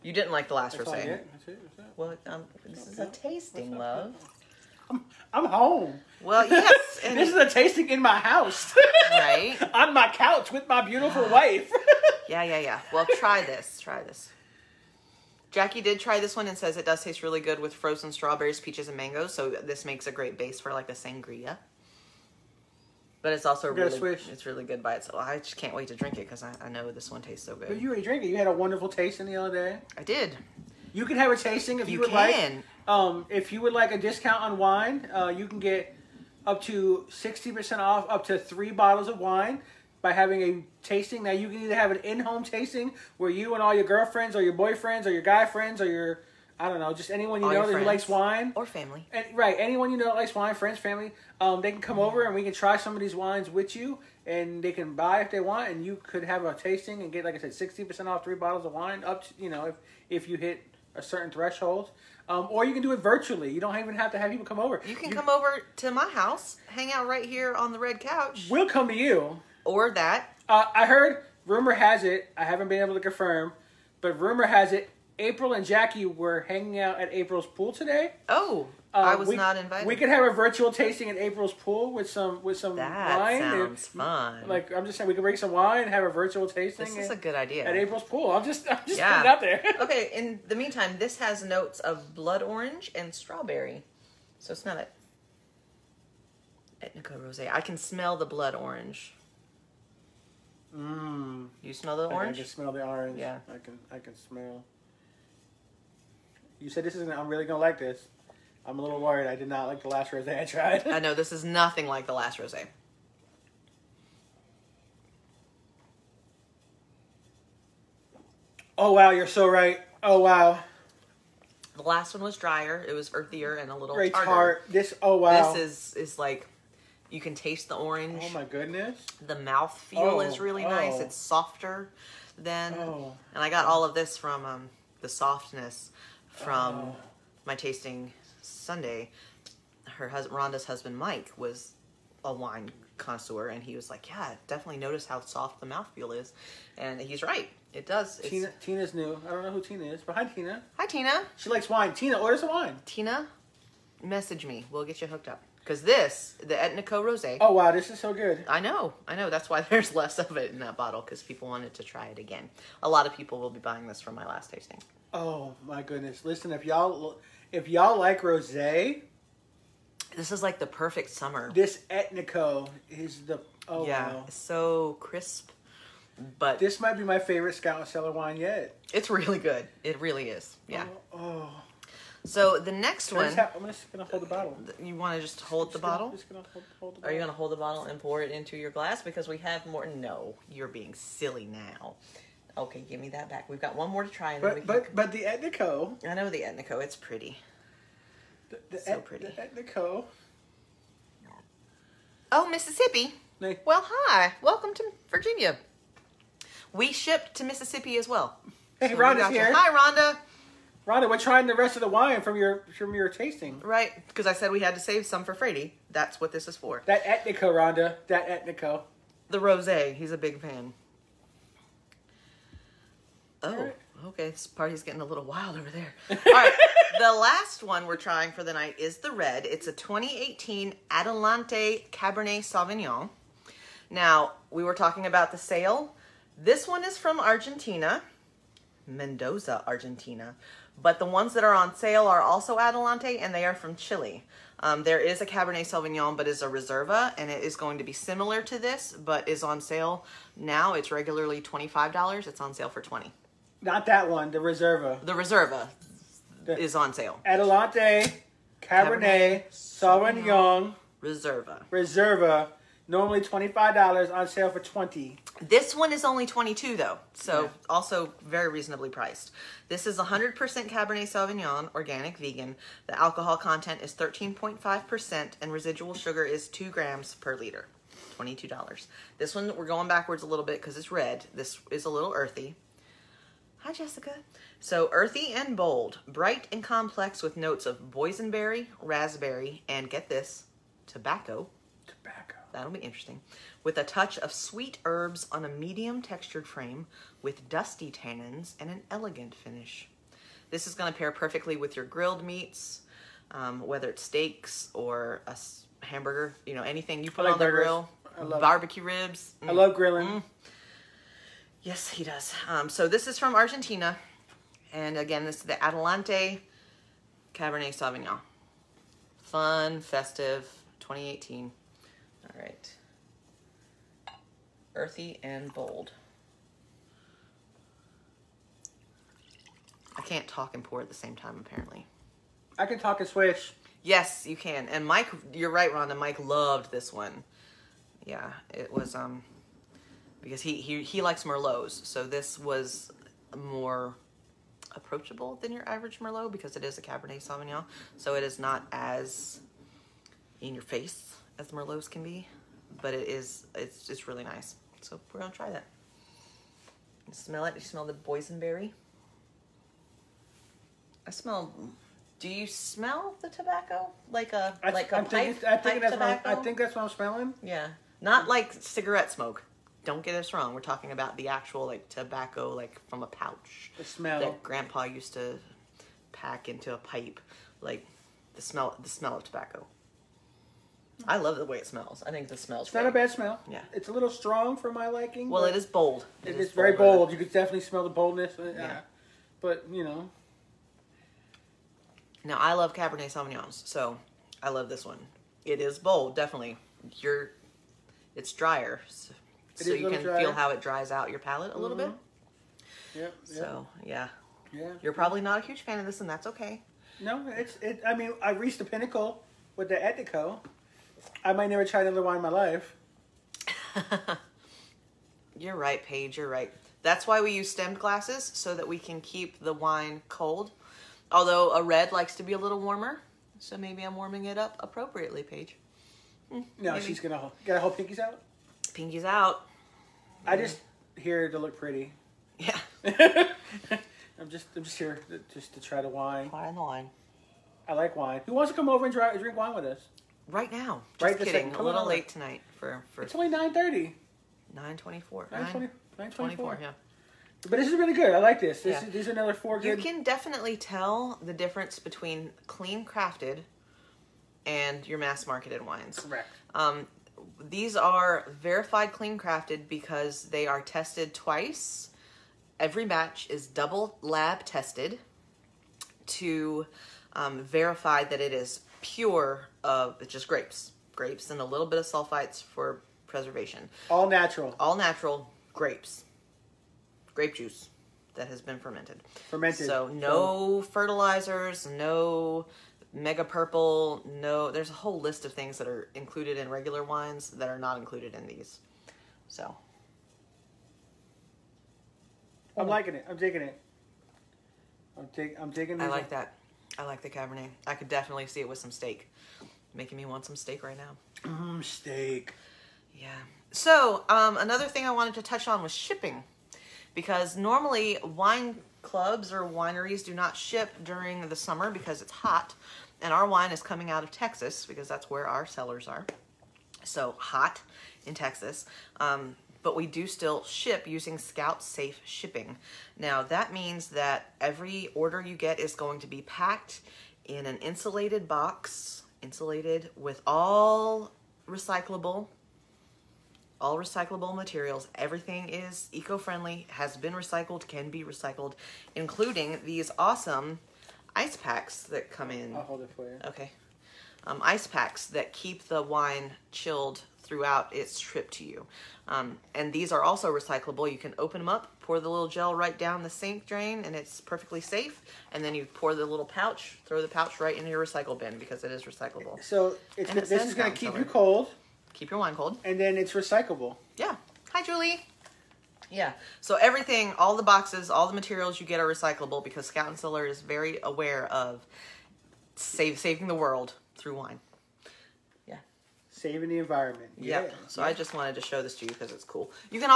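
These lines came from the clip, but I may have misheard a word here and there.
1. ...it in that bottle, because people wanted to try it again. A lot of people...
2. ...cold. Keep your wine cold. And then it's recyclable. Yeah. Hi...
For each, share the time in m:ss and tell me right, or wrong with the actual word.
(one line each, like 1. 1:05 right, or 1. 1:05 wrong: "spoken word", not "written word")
1. 2:40 right
2. 9:21 right.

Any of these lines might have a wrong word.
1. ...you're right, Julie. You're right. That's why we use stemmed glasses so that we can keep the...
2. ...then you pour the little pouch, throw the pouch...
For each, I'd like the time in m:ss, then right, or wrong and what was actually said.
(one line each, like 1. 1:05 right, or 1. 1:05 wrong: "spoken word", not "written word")
1. 6:55 wrong: "Paige", not "Julie"
2. 9:15 right.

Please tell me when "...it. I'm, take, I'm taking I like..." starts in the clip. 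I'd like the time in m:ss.
8:13.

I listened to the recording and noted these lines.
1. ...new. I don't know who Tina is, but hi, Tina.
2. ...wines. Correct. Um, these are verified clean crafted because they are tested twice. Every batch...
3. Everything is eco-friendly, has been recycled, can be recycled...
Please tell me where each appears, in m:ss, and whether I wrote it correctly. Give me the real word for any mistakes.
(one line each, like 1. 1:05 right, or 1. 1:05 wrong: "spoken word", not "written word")
1. 2:28 right
2. 7:35 right
3. 8:54 right.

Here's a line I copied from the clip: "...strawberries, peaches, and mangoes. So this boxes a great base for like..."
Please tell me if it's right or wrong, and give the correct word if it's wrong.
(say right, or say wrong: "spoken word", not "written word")
wrong: "makes", not "boxes".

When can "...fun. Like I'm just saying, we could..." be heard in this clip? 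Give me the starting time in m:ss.
1:24.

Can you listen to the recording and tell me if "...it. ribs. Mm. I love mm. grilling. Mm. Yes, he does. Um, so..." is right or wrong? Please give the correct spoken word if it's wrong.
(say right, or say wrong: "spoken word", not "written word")
right.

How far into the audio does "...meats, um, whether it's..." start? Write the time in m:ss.
5:02.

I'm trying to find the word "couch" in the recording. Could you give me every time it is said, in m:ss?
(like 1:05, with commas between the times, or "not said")
0:10, 1:07.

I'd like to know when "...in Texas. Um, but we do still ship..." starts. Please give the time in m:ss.
8:38.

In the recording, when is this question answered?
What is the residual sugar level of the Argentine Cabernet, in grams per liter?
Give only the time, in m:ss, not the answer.
4:36.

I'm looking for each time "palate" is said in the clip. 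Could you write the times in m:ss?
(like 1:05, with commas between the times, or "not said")
6:41.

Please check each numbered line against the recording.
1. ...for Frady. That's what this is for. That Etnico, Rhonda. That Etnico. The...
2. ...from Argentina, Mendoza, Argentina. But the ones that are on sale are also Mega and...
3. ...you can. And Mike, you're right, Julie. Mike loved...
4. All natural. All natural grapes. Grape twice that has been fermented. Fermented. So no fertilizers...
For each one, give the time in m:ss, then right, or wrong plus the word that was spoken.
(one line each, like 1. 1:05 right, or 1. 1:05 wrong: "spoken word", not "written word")
1. 3:35 right
2. 3:56 wrong: "Adelante", not "Mega"
3. 5:34 wrong: "Rhonda", not "Julie"
4. 7:53 wrong: "juice", not "twice".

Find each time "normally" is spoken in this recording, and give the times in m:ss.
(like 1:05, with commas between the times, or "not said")
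4:22, 8:27.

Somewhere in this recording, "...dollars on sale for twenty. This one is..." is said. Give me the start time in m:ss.
4:23.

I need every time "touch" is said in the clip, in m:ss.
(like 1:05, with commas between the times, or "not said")
4:53, 8:25.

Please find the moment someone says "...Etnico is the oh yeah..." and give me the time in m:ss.
2:51.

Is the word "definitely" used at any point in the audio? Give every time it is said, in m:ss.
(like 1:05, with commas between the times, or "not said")
2:24, 6:27, 6:36, 7:30, 8:17.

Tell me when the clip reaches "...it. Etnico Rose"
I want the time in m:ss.
1:34.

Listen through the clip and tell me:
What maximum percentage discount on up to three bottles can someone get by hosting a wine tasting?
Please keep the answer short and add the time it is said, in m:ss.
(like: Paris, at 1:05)
60%, at 0:37.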